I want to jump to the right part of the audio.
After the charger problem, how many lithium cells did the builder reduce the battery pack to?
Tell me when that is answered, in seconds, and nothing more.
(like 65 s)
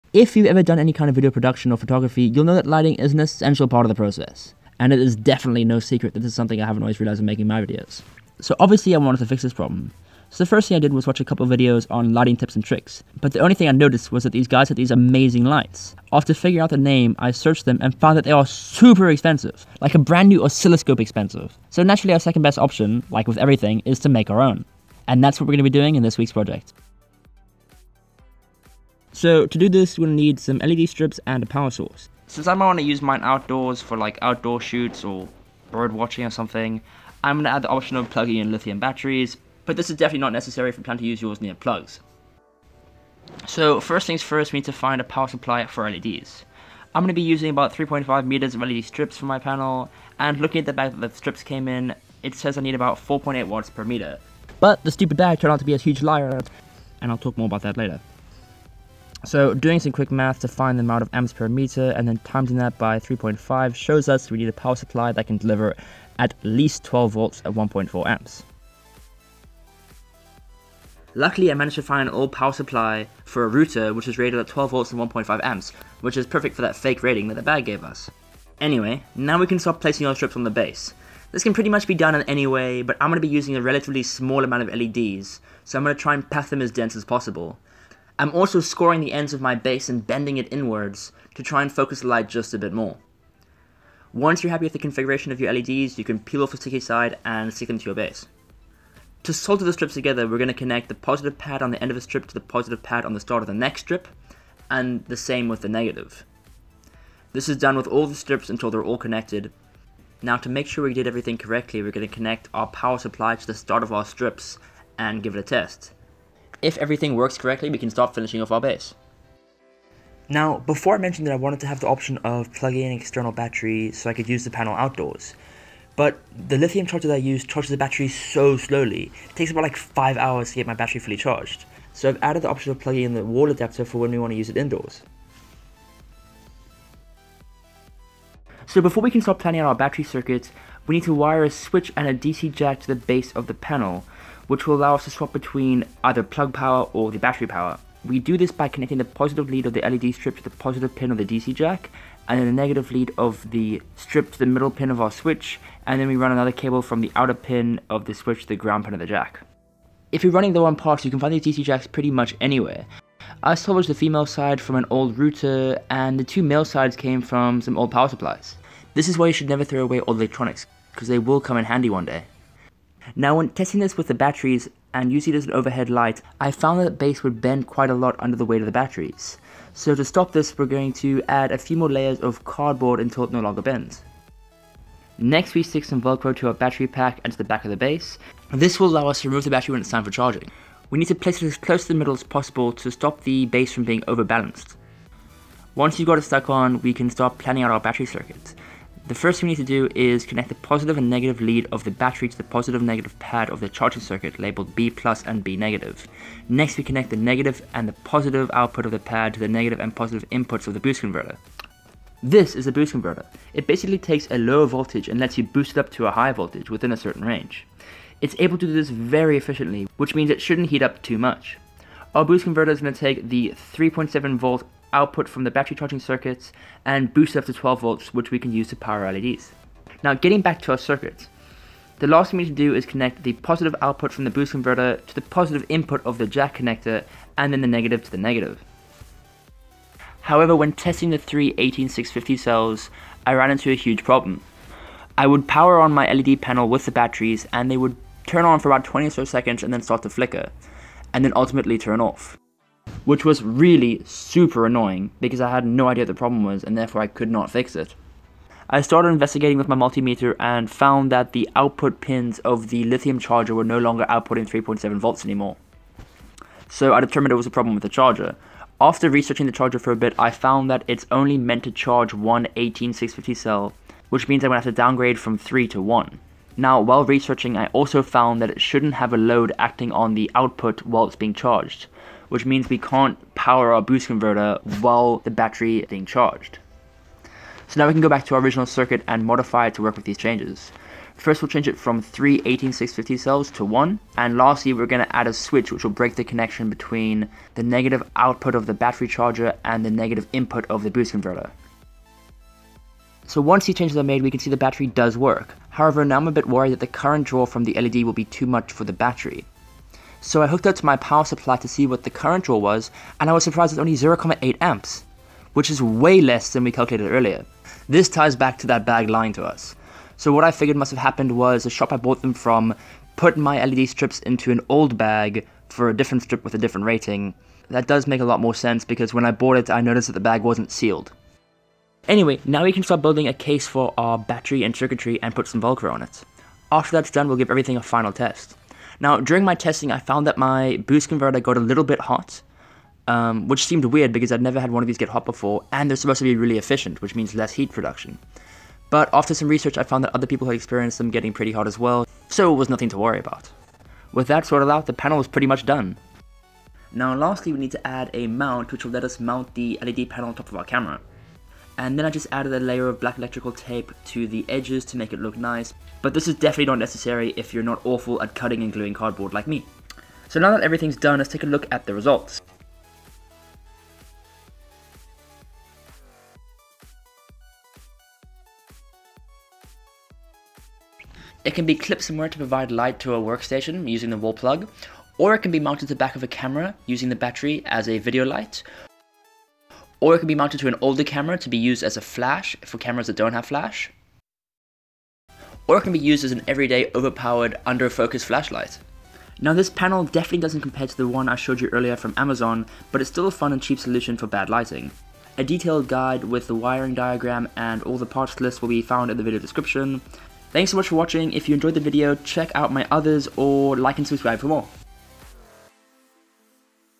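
275 s.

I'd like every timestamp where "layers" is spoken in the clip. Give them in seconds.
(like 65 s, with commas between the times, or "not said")
181 s, 362 s.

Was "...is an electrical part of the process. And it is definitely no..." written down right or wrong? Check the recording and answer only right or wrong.
wrong.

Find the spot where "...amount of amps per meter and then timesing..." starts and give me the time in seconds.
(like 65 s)
60 s.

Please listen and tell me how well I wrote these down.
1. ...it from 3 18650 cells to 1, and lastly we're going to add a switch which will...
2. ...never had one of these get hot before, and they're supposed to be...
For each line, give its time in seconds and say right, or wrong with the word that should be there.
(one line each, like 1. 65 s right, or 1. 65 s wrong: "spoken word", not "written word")
1. 291 s right
2. 344 s right.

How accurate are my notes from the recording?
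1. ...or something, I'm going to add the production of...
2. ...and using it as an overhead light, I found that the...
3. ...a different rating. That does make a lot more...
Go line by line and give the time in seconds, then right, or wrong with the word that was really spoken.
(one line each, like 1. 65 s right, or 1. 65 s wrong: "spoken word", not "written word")
1. 36 s wrong: "option", not "production"
2. 174 s right
3. 326 s right.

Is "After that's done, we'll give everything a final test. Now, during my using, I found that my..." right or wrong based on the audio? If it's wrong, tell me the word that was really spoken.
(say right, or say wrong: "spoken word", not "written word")
wrong: "testing", not "using".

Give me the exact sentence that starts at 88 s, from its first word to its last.
I'm also scoring the ends of my base and bending it inwards to try and focus the light just a bit more.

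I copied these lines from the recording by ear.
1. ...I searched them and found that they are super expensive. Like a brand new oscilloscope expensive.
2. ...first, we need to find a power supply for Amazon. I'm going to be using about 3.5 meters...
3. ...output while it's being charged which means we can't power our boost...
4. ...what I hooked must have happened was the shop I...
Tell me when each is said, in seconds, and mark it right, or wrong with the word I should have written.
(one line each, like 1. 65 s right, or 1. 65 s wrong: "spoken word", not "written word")
1. 17 s right
2. 44 s wrong: "LEDs", not "Amazon"
3. 280 s right
4. 320 s wrong: "figured", not "hooked".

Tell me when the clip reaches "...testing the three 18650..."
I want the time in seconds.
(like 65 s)
240 s.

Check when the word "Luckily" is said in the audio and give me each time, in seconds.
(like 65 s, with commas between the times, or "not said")
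71 s.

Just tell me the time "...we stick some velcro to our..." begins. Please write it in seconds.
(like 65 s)
185 s.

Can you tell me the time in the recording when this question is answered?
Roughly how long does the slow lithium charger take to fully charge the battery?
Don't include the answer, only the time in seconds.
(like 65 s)
129 s.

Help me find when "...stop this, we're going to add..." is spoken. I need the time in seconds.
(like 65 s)
180 s.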